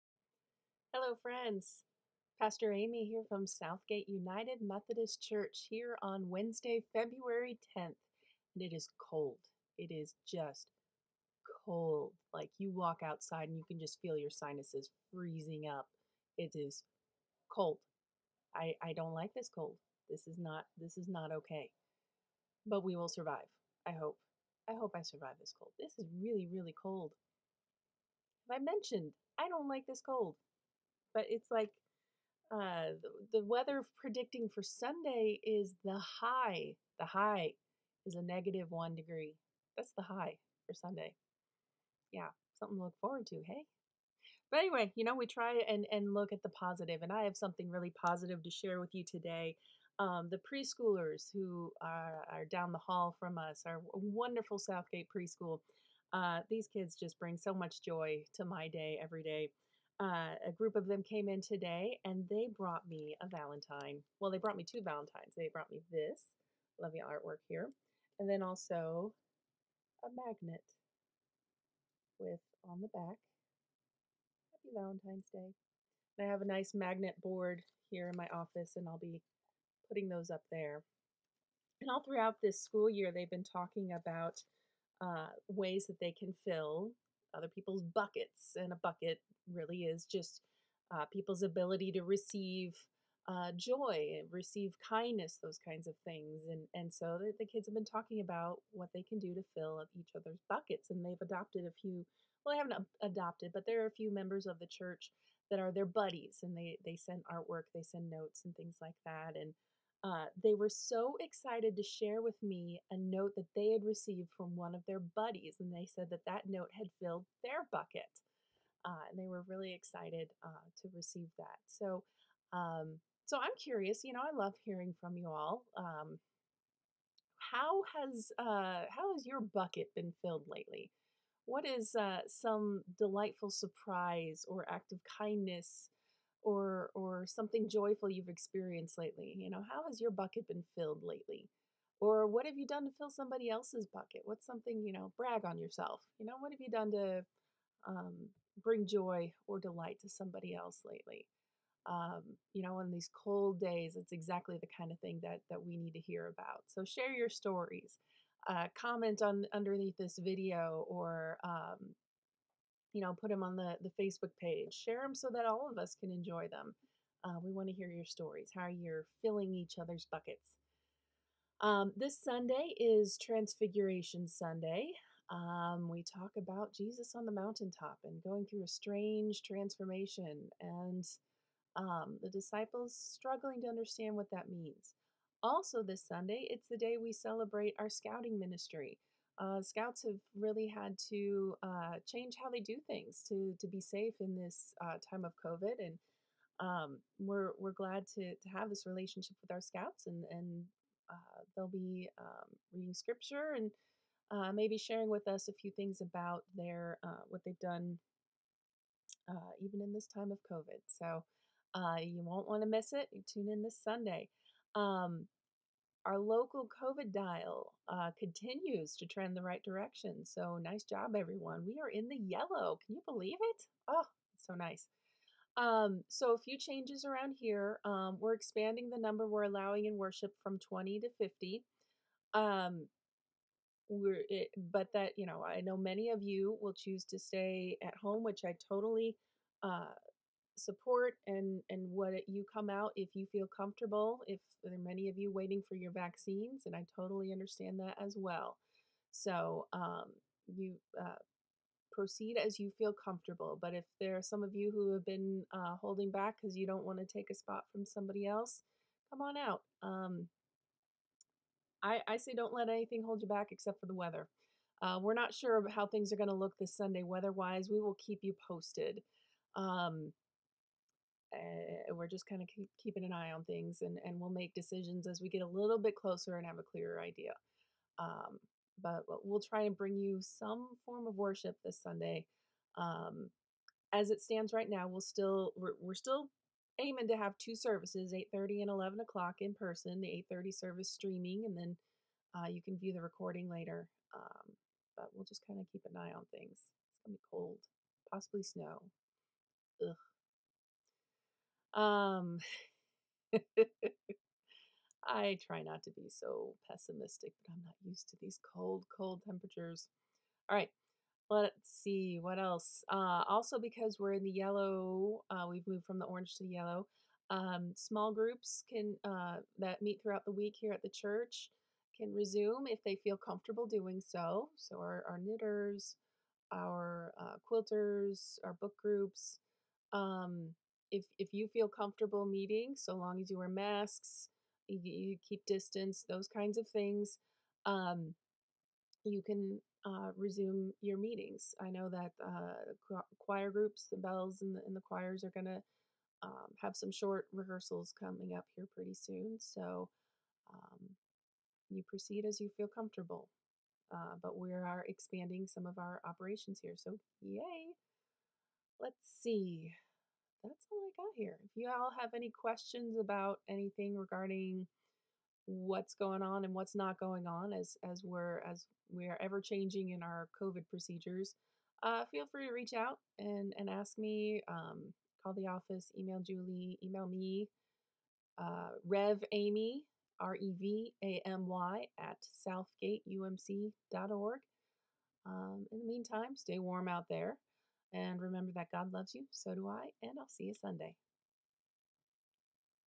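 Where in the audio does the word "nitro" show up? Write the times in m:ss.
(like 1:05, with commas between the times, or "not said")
not said.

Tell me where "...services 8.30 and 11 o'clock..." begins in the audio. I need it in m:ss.
4:47.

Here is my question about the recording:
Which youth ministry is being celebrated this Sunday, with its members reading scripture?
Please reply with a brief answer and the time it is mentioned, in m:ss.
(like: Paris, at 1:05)
Scouting, at 3:07.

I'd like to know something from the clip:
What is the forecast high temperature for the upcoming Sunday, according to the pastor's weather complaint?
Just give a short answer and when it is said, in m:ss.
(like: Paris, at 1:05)
-1 degree, at 0:38.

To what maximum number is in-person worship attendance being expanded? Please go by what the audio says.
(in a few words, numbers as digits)
50.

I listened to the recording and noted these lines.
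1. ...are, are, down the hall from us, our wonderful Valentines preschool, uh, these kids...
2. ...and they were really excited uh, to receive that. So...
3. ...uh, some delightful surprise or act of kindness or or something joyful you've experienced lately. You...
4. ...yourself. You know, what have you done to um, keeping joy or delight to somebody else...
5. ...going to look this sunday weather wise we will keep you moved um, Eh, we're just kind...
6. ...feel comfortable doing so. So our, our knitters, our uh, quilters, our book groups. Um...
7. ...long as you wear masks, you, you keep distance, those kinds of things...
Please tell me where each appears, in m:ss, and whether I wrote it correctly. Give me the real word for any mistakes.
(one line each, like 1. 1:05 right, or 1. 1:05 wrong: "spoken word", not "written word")
1. 0:51 wrong: "Southgate", not "Valentines"
2. 1:59 right
3. 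2:11 right
4. 2:25 wrong: "bring", not "keeping"
5. 4:26 wrong: "posted", not "moved"
6. 5:23 right
7. 5:32 right.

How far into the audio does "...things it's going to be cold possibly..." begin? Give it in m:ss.
4:56.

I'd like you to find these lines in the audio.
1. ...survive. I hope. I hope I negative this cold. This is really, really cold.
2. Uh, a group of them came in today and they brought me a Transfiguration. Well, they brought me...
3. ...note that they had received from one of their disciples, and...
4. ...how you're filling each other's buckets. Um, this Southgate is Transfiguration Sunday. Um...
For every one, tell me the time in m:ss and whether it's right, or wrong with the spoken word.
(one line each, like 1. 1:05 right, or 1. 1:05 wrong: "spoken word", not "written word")
1. 0:23 wrong: "survive", not "negative"
2. 1:00 wrong: "Valentine", not "Transfiguration"
3. 1:52 wrong: "buddies", not "disciples"
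4. 2:48 wrong: "Sunday", not "Southgate".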